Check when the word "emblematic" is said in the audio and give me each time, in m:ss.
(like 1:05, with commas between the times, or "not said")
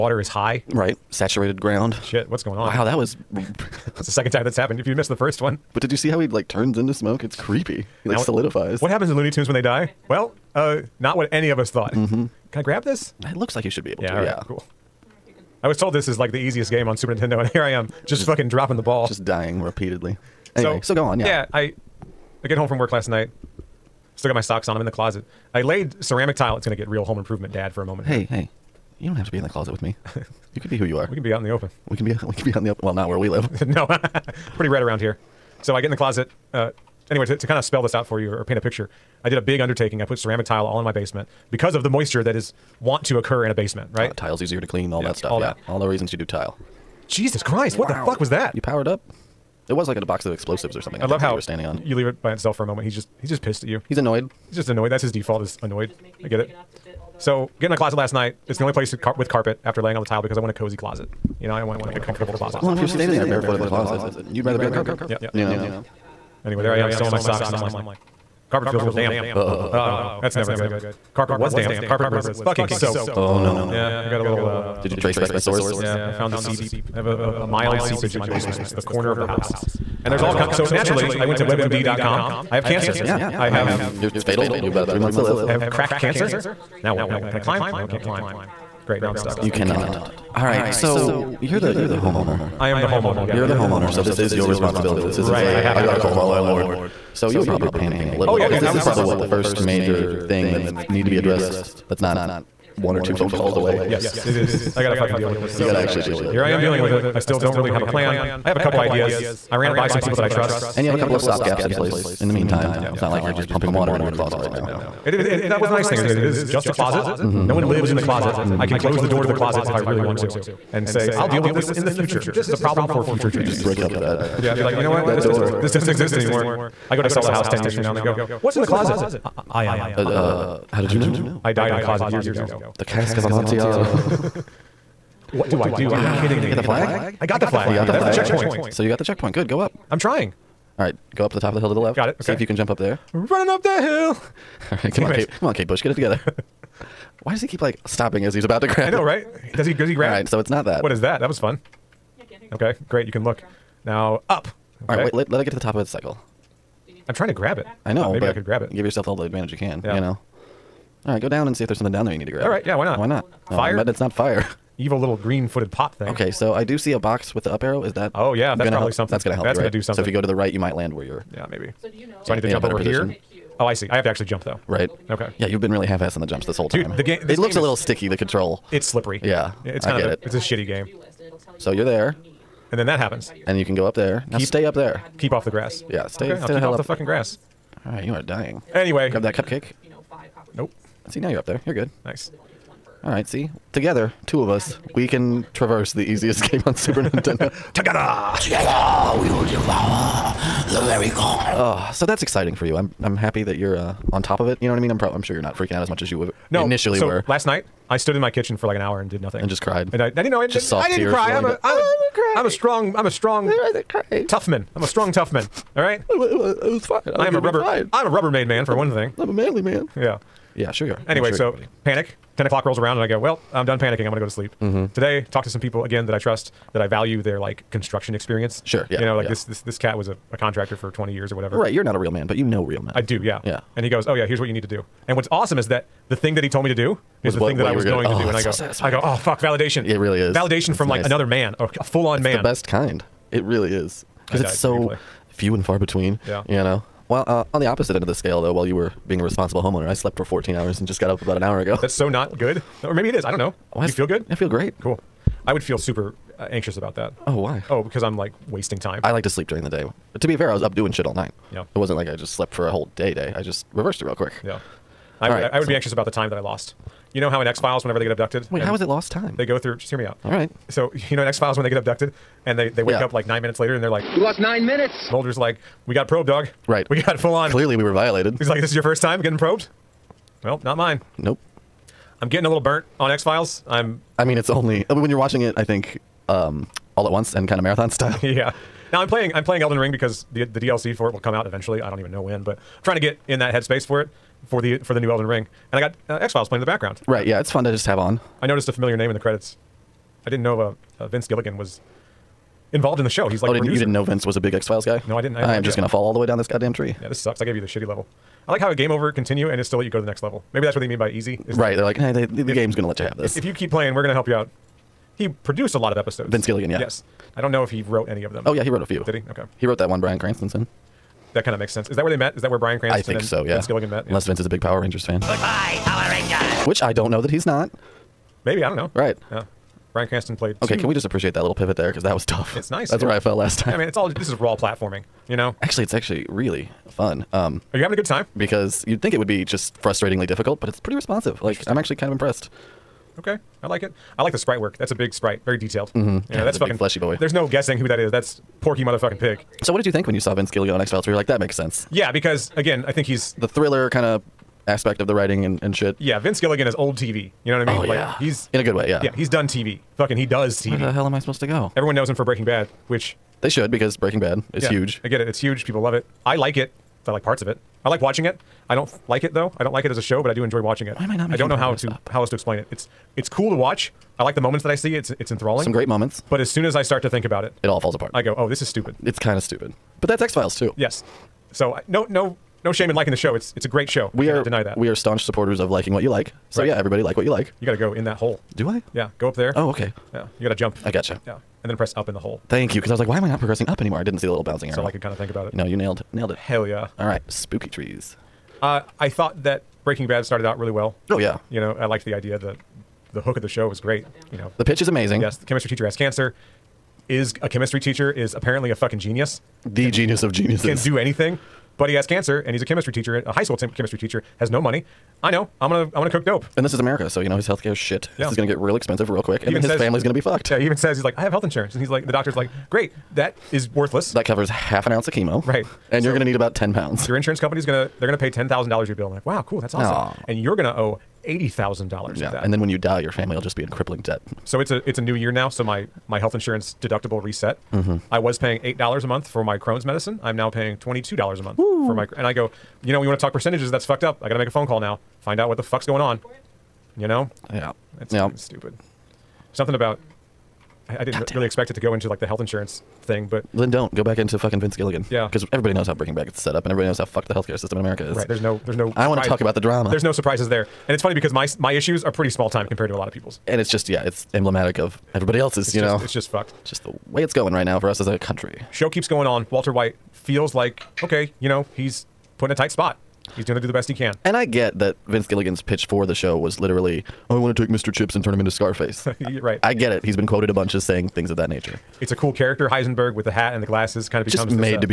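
7:44.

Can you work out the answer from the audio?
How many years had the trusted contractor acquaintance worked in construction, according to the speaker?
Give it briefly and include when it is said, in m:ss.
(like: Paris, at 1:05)
20, at 3:50.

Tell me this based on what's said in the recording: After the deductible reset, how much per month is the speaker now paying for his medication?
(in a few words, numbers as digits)
$22.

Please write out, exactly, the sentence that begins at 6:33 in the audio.
I didn't see the little bouncing arrow.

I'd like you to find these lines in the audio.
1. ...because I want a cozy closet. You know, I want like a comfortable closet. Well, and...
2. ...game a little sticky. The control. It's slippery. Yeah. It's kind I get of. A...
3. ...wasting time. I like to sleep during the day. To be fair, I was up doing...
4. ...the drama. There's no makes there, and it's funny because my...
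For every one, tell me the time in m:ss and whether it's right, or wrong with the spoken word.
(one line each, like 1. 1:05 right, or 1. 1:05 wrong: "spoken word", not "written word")
1. 1:00 right
2. 2:57 right
3. 4:18 right
4. 7:39 wrong: "surprises", not "makes".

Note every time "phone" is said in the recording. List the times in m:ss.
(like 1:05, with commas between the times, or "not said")
1:43, 7:24.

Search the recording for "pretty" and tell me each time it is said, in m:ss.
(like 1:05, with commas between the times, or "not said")
0:34, 5:40, 7:42.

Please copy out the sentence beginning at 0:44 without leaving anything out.
Uh, tile's easier to clean, all yeah, that stuff.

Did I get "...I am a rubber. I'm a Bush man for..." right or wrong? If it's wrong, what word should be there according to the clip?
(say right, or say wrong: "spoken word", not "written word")
wrong: "Rubbermaid", not "Bush".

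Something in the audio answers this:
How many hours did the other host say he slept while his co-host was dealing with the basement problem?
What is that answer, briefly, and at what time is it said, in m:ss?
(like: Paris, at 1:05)
14, at 4:10.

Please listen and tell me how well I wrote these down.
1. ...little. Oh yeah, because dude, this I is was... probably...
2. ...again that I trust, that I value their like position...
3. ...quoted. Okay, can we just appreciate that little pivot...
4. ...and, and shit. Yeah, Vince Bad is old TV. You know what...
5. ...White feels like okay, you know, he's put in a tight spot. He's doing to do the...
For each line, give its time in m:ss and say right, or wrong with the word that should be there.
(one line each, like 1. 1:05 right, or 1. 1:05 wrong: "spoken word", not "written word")
1. 1:38 right
2. 3:45 wrong: "construction", not "position"
3. 5:30 wrong: "played", not "quoted"
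4. 5:55 wrong: "Gilligan", not "Bad"
5. 7:49 right.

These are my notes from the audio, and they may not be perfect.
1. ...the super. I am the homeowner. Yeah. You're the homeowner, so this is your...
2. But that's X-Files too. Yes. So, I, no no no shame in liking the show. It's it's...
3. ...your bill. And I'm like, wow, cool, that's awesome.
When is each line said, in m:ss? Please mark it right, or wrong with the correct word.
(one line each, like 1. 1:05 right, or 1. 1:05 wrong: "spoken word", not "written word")
1. 1:31 wrong: "homeowner", not "super"
2. 6:20 right
3. 7:08 right.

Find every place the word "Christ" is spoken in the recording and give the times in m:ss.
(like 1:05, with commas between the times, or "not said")
0:47.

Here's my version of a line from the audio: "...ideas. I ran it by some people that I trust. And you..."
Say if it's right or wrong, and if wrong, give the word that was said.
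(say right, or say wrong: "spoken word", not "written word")
right.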